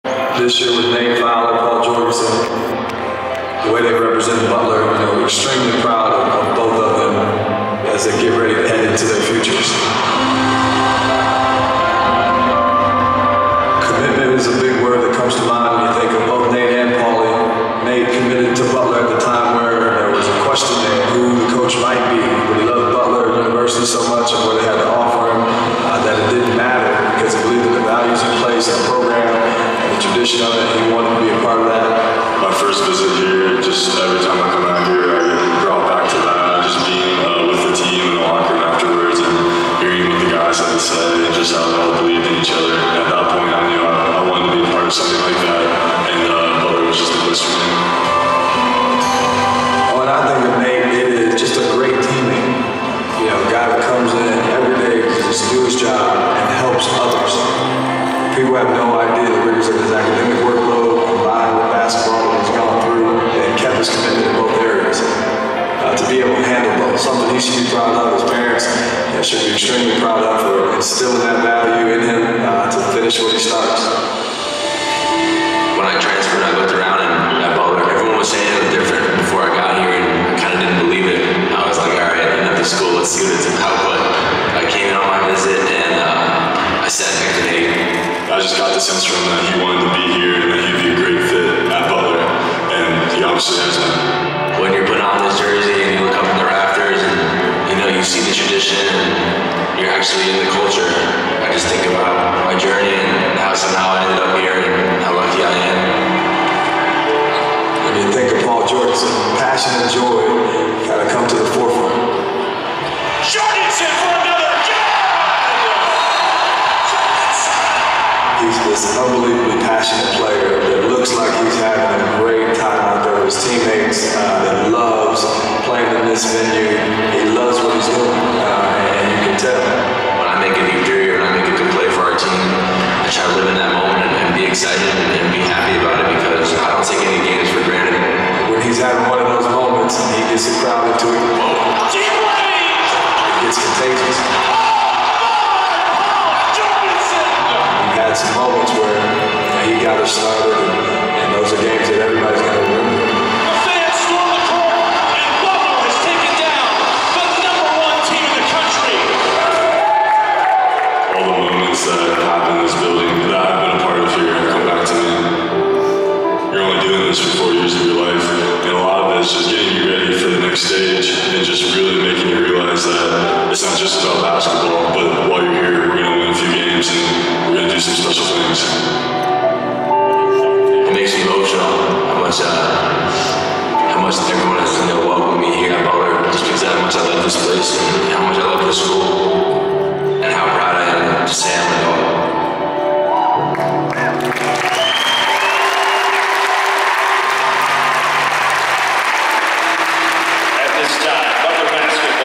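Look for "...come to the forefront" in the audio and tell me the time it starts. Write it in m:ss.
1:51.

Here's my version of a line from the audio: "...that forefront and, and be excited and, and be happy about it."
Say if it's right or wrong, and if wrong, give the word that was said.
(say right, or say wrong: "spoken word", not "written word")
wrong: "moment", not "forefront".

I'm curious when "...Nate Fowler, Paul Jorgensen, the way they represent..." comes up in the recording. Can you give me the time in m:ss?
0:00.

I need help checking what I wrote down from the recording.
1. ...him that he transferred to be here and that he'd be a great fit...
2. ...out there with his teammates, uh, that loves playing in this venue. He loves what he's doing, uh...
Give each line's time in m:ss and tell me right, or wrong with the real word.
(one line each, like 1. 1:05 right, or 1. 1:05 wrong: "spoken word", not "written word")
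1. 1:29 wrong: "wanted", not "transferred"
2. 2:02 right.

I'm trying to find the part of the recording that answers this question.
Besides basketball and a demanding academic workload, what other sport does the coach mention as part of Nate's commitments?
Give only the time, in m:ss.
1:02.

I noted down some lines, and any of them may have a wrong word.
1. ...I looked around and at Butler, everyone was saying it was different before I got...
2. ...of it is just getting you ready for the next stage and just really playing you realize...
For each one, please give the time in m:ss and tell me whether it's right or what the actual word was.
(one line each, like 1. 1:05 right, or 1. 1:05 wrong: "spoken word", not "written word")
1. 1:16 right
2. 2:49 wrong: "making", not "playing".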